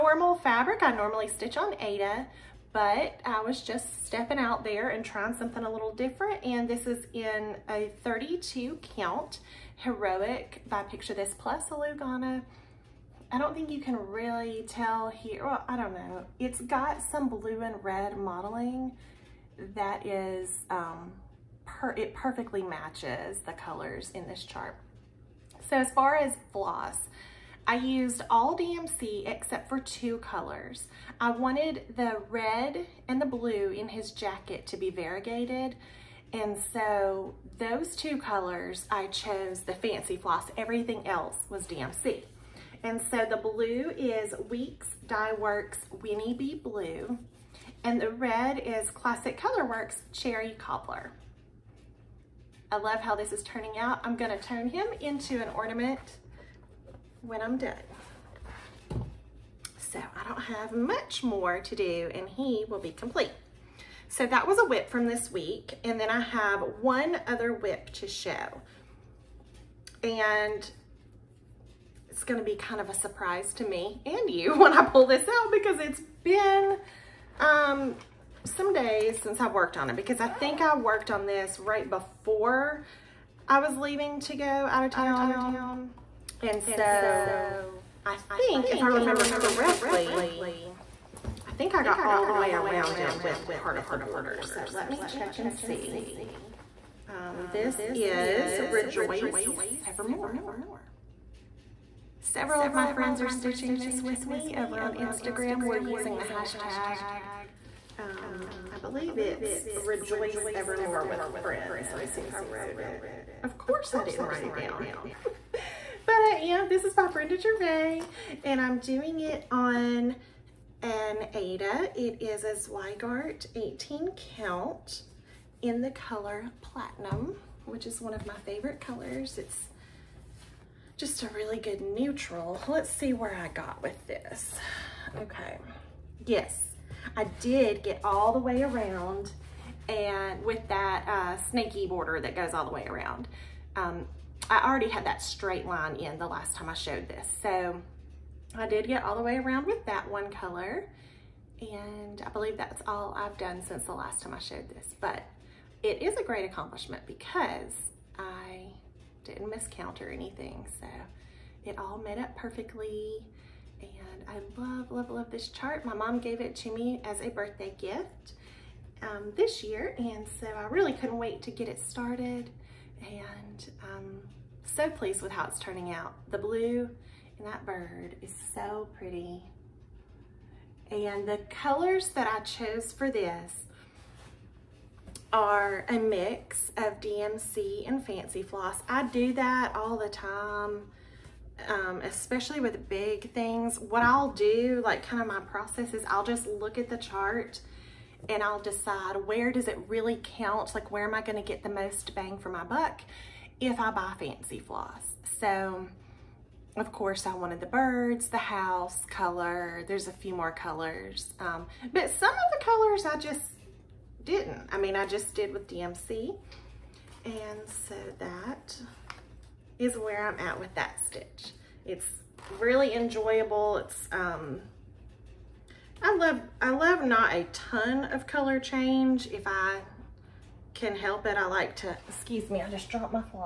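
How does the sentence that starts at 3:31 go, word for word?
Um, but some of the colors I just didn't.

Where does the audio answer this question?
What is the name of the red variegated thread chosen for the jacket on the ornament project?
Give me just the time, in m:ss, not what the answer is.
0:50.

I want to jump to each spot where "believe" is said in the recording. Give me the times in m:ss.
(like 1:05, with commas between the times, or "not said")
1:48, 2:32.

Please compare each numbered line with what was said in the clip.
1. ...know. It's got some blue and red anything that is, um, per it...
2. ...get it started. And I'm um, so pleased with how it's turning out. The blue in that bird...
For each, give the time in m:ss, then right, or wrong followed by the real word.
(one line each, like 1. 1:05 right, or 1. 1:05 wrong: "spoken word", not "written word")
1. 0:15 wrong: "modeling", not "anything"
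2. 2:51 right.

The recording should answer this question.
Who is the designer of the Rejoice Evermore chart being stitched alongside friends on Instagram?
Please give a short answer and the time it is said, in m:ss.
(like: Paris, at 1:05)
Brenda Gervais, at 1:57.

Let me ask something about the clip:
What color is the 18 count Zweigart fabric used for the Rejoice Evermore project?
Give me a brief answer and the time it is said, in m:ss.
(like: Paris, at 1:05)
Platinum, at 2:06.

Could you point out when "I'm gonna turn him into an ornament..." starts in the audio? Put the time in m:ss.
0:54.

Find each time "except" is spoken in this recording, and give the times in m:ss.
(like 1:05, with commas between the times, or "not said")
0:29.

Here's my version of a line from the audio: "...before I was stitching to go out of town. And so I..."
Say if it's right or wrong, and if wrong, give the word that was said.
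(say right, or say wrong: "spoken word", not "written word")
wrong: "leaving", not "stitching".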